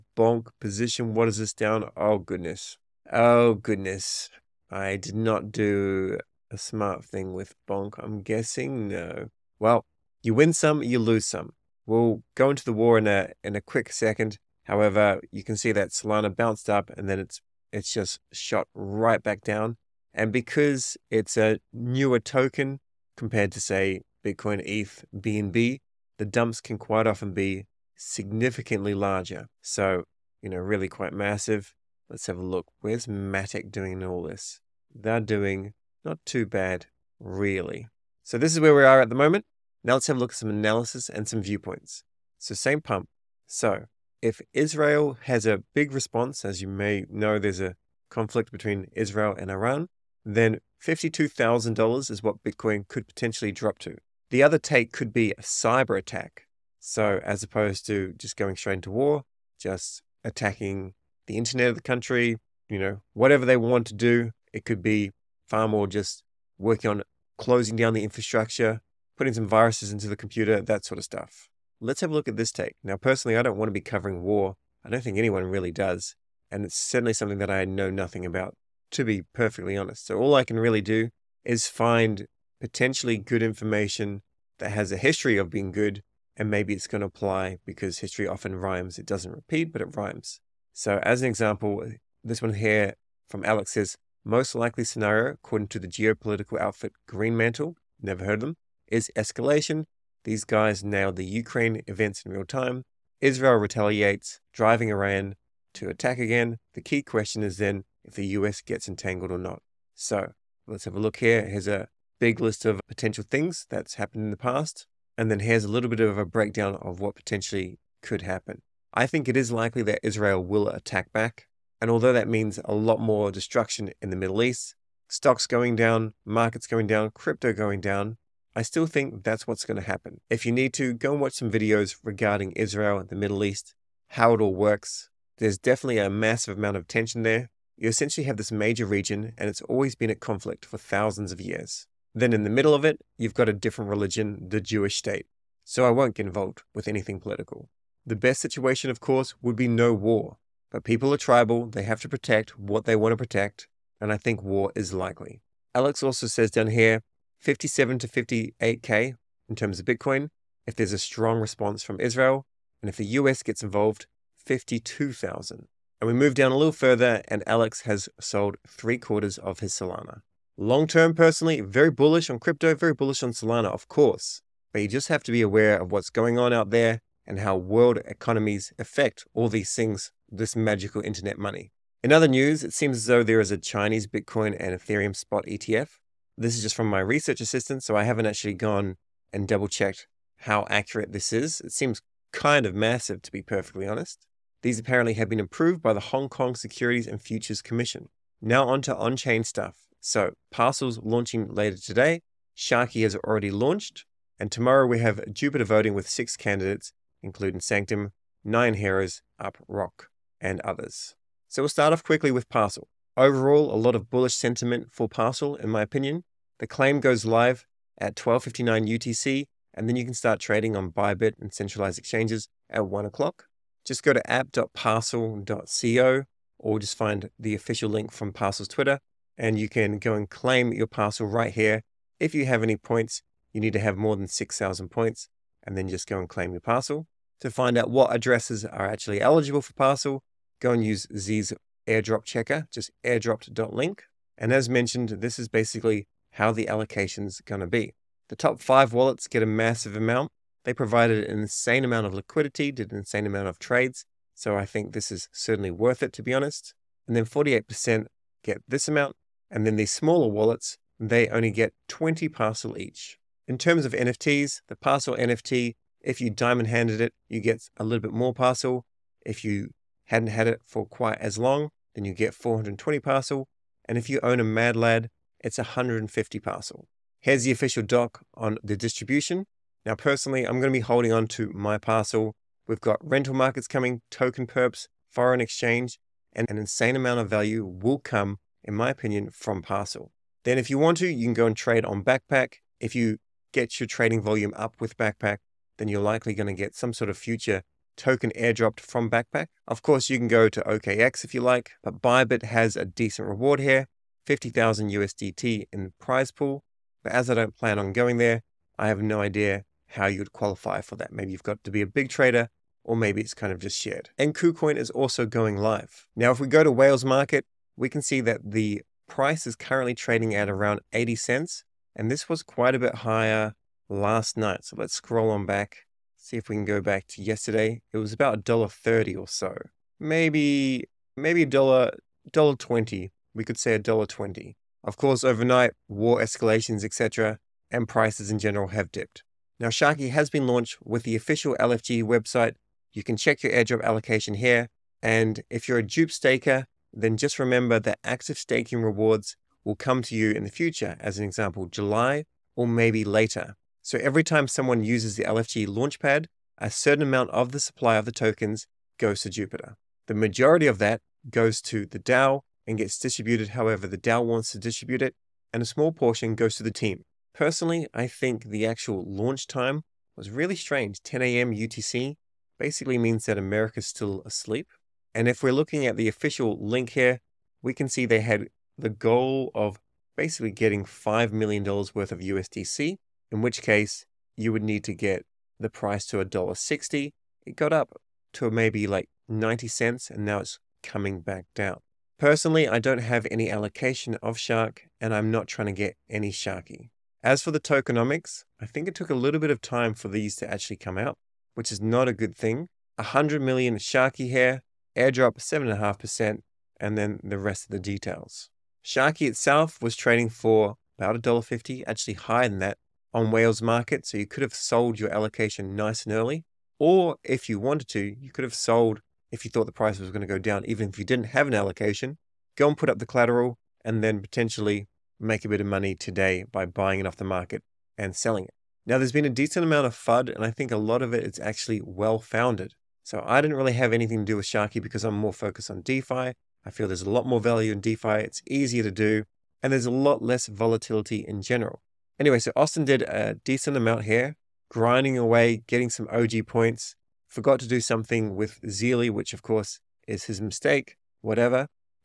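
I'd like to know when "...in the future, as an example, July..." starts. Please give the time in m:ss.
5:50.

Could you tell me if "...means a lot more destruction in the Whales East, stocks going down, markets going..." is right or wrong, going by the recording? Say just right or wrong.
wrong.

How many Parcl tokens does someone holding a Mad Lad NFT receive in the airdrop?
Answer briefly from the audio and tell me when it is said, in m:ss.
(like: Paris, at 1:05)
150, at 4:35.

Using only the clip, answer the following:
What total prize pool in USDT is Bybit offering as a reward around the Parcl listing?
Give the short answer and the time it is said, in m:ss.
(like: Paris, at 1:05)
50,000 USDT, at 5:04.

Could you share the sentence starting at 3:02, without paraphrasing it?
In other news, it seems as though there is a Chinese Bitcoin and Ethereum spot ETF.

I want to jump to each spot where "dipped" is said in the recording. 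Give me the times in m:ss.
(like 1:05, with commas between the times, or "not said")
5:38.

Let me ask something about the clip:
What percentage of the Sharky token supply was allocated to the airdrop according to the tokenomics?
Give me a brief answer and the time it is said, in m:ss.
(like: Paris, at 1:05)
7.5%, at 6:45.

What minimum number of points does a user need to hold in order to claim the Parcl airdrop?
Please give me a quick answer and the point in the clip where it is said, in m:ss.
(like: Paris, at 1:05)
6,000, at 3:54.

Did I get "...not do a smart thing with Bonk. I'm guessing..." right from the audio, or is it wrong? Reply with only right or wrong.
right.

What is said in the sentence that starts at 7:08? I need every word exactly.
Now, there's been a decent amount of FUD, and I think a lot of it is actually well founded.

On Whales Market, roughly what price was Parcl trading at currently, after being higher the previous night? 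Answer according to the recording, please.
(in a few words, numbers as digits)
80 cents.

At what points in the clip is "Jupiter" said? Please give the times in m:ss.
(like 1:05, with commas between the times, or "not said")
3:25, 5:59.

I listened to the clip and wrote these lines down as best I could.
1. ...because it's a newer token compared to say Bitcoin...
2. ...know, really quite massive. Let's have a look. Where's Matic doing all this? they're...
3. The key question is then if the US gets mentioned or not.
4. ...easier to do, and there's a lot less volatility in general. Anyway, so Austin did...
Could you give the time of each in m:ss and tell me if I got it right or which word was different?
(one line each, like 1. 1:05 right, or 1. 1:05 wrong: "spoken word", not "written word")
1. 0:20 right
2. 0:30 right
3. 1:46 wrong: "entangled", not "mentioned"
4. 7:18 right.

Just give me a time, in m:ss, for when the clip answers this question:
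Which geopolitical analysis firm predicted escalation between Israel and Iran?
1:37.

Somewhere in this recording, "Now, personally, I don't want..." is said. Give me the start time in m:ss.
1:12.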